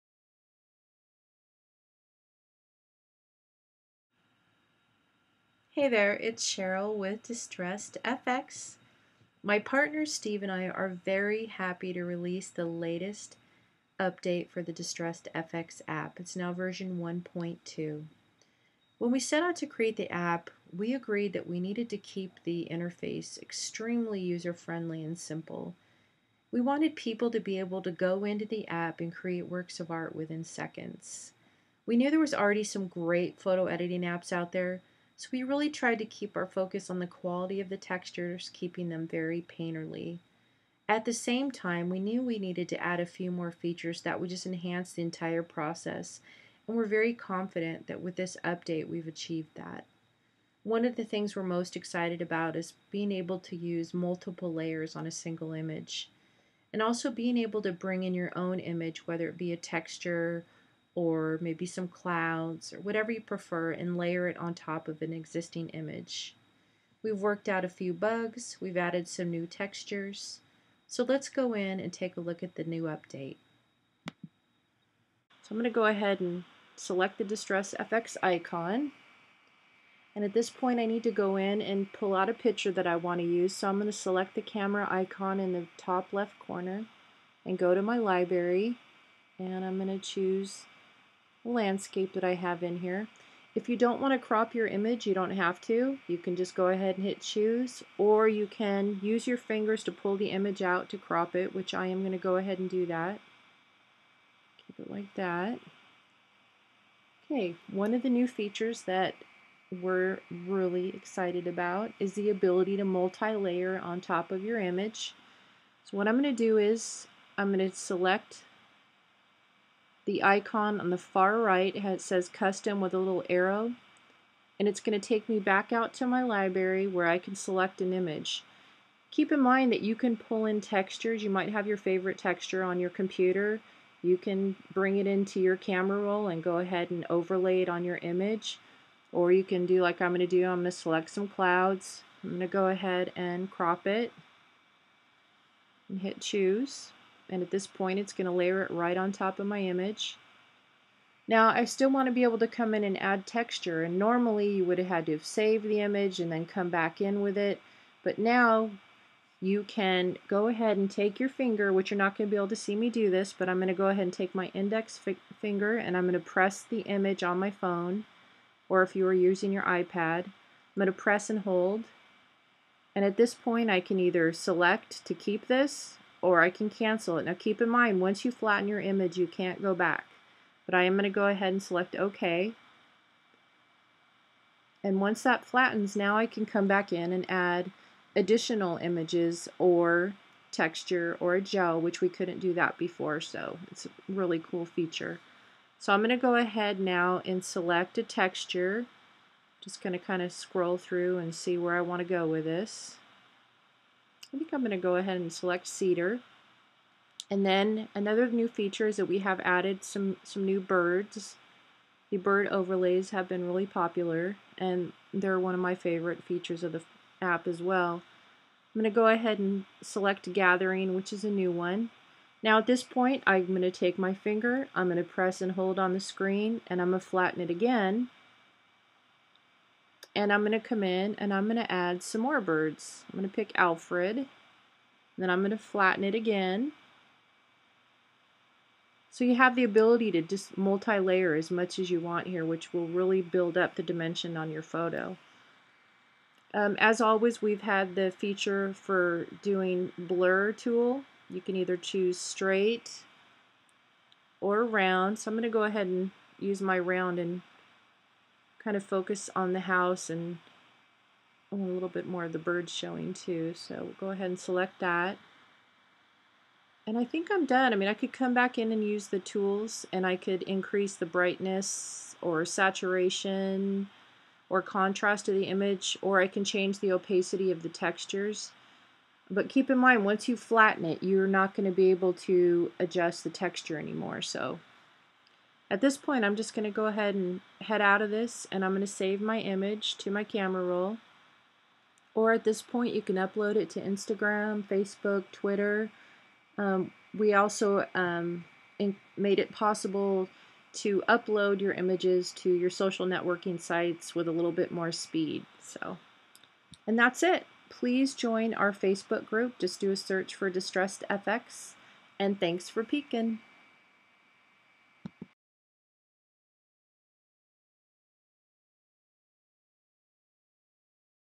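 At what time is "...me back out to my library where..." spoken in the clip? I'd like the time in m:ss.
2:05.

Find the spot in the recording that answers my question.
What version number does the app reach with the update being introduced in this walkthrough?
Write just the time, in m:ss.
0:16.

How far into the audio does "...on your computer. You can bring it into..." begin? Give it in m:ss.
2:12.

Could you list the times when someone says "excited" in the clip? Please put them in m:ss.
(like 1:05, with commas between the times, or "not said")
0:51, 1:50.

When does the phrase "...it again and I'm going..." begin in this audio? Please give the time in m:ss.
3:47.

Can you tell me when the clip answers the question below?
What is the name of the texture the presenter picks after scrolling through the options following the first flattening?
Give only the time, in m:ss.
3:25.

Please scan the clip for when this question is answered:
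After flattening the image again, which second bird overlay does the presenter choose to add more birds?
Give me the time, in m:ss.
3:53.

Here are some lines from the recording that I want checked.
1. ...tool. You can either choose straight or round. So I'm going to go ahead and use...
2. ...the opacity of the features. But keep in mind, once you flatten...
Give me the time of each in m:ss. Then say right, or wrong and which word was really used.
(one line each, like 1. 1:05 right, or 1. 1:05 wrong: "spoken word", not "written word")
1. 4:10 right
2. 4:36 wrong: "textures", not "features".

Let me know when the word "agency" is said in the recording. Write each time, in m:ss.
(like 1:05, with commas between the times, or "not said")
not said.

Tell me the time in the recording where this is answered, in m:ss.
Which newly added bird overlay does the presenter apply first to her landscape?
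3:40.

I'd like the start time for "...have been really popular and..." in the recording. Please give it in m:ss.
3:33.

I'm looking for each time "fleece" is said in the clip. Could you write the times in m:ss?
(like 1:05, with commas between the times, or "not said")
not said.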